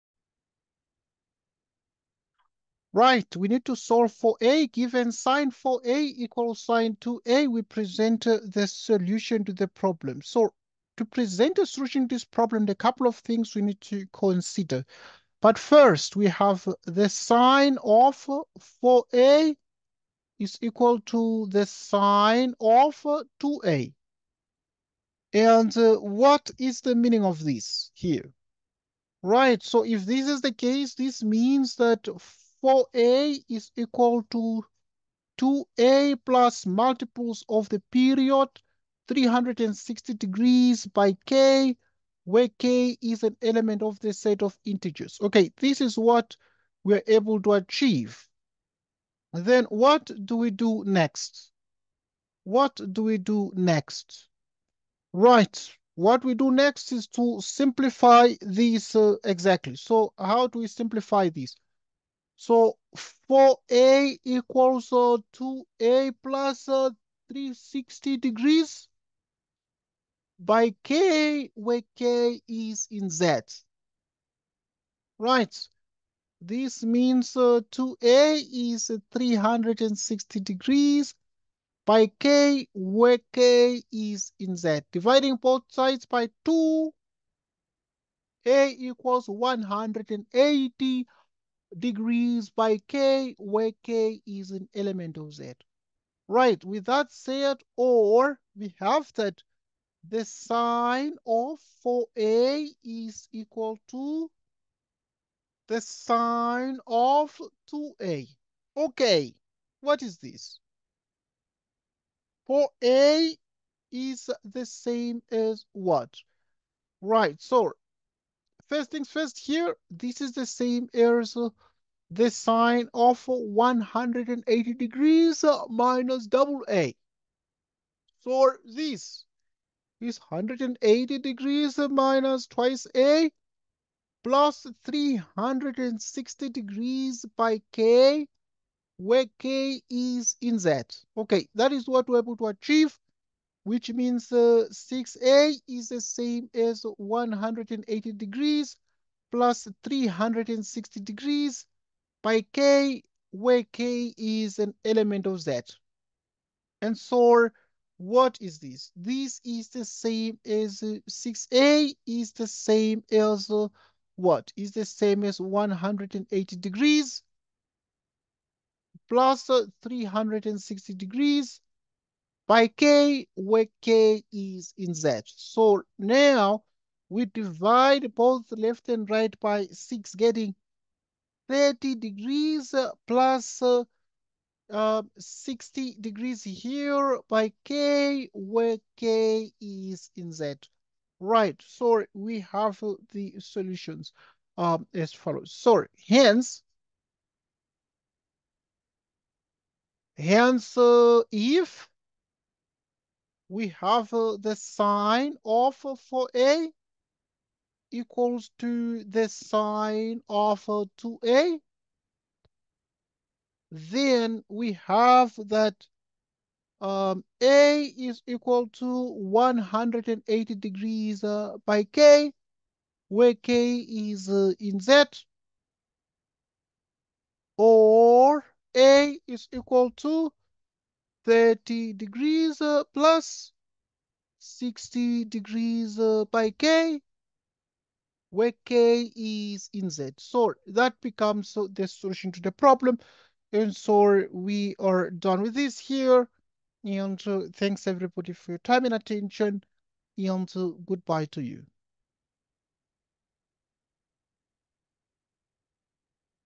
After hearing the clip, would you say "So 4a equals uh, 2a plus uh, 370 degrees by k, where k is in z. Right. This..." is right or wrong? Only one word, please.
wrong.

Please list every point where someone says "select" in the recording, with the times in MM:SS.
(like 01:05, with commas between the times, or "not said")
not said.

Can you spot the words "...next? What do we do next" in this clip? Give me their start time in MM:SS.
00:50.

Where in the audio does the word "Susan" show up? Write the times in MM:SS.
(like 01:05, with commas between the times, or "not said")
not said.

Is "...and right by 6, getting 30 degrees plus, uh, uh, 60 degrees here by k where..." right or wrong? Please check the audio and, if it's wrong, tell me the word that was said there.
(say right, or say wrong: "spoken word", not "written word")
right.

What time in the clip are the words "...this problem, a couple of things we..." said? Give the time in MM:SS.
00:12.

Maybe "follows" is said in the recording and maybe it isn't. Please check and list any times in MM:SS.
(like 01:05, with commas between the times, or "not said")
03:15.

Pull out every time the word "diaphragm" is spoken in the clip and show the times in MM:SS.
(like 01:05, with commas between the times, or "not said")
not said.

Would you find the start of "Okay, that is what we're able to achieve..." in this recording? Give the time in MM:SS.
02:21.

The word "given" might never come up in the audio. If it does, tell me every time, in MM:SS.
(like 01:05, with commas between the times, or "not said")
00:04.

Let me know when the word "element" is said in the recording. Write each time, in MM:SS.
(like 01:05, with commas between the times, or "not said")
00:43, 01:34, 02:34.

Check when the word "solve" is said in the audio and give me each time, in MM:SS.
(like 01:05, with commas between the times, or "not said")
00:03.